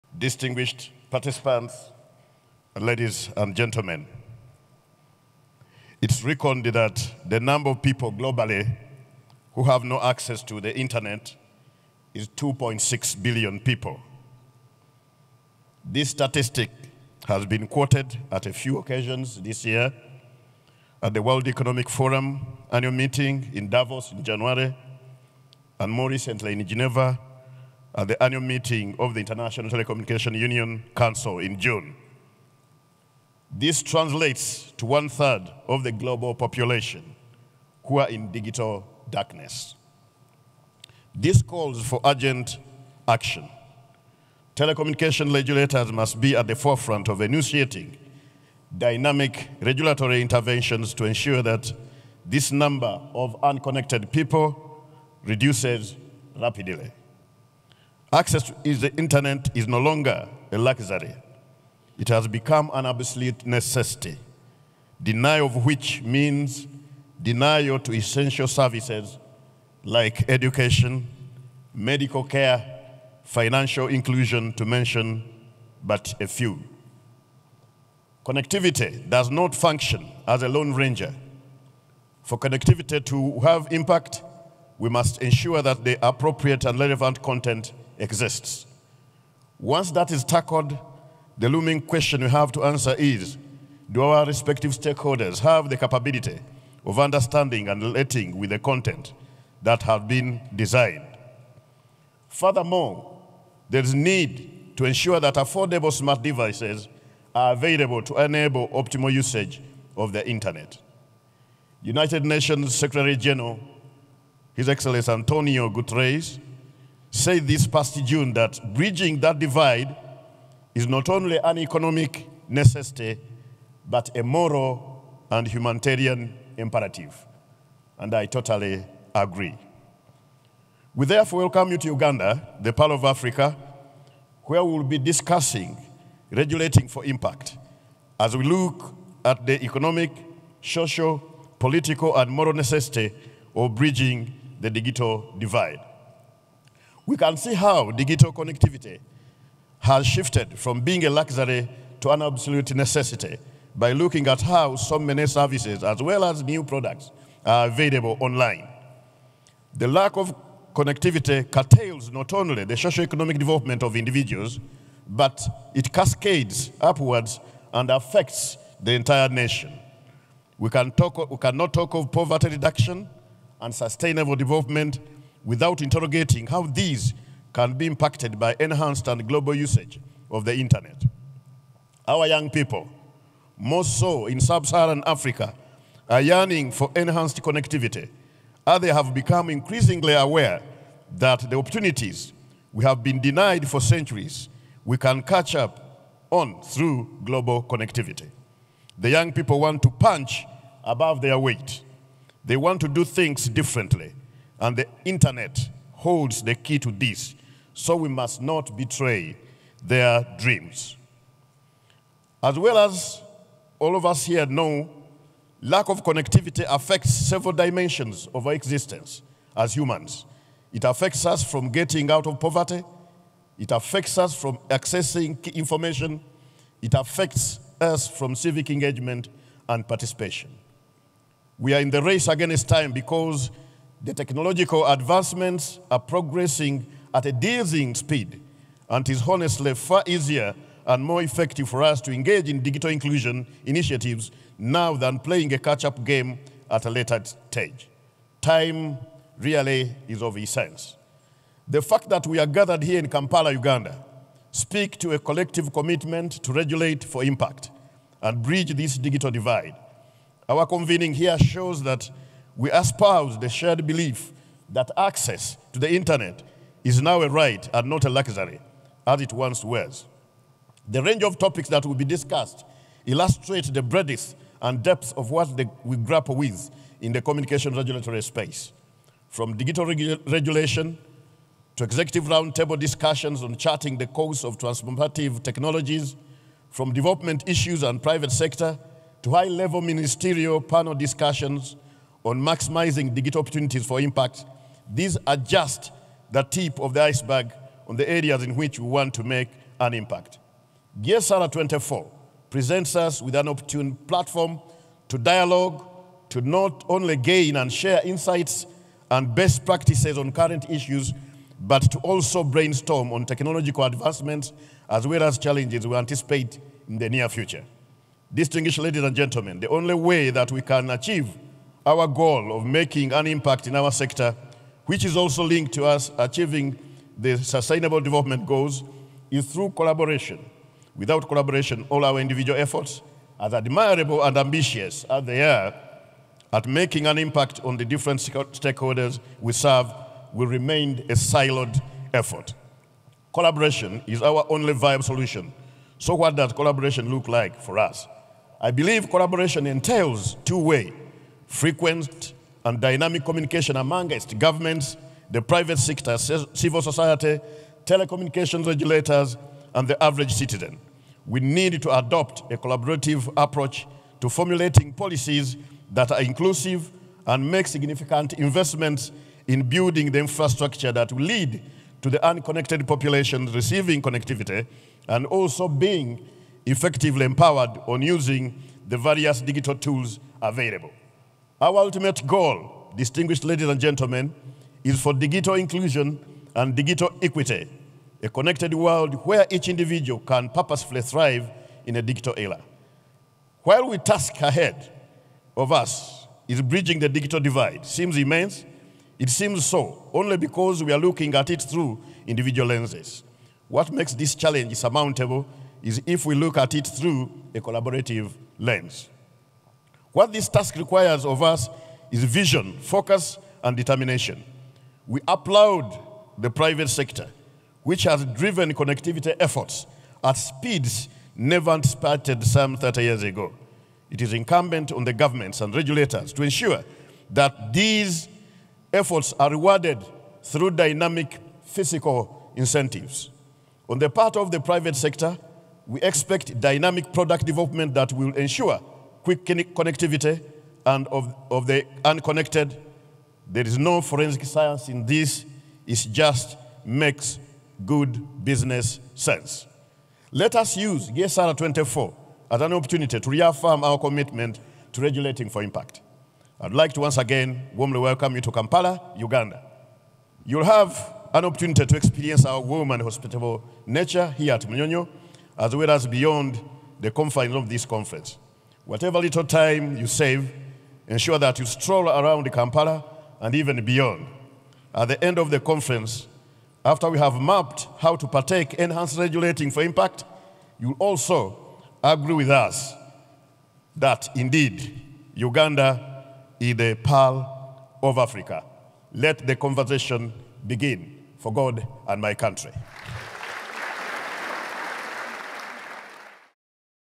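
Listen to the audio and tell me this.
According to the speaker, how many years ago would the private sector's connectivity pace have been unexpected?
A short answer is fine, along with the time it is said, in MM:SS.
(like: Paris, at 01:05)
30, at 07:02.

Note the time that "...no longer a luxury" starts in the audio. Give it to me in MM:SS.
00:59.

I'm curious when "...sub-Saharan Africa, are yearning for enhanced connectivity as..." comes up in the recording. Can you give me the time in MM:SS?
03:04.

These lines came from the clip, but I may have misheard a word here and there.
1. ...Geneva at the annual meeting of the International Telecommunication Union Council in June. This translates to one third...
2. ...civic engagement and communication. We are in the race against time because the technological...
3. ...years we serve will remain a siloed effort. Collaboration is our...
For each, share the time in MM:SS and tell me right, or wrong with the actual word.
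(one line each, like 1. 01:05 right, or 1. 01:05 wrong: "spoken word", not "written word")
1. 00:26 right
2. 03:48 wrong: "participation", not "communication"
3. 05:38 wrong: "stakeholders", not "years".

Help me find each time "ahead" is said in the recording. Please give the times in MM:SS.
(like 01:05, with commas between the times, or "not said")
06:34.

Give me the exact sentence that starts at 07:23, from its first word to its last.
There is no forensic science in this.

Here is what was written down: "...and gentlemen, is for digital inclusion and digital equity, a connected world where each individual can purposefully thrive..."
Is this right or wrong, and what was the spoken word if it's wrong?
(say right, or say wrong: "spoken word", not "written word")
right.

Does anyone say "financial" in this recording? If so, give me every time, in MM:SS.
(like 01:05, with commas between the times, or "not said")
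01:13.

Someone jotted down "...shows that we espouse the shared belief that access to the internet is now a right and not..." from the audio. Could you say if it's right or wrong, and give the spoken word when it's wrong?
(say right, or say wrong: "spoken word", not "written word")
right.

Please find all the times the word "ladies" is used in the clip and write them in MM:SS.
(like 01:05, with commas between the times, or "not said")
00:02, 05:18, 06:23.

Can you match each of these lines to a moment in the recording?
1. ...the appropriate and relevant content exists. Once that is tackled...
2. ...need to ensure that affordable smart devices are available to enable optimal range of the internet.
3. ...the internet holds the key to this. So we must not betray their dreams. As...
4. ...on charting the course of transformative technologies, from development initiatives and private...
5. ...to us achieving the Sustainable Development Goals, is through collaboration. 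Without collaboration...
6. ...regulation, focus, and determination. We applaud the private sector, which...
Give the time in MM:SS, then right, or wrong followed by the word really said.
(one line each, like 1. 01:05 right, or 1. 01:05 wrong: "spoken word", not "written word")
1. 01:25 right
2. 01:43 wrong: "usage", not "range"
3. 03:24 right
4. 04:43 wrong: "issues", not "initiatives"
5. 05:25 right
6. 06:52 wrong: "vision", not "regulation".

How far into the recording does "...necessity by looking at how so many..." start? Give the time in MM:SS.
02:32.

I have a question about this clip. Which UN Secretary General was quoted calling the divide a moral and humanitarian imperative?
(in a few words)
Antonio Guterres.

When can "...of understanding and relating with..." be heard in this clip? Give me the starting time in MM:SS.
01:36.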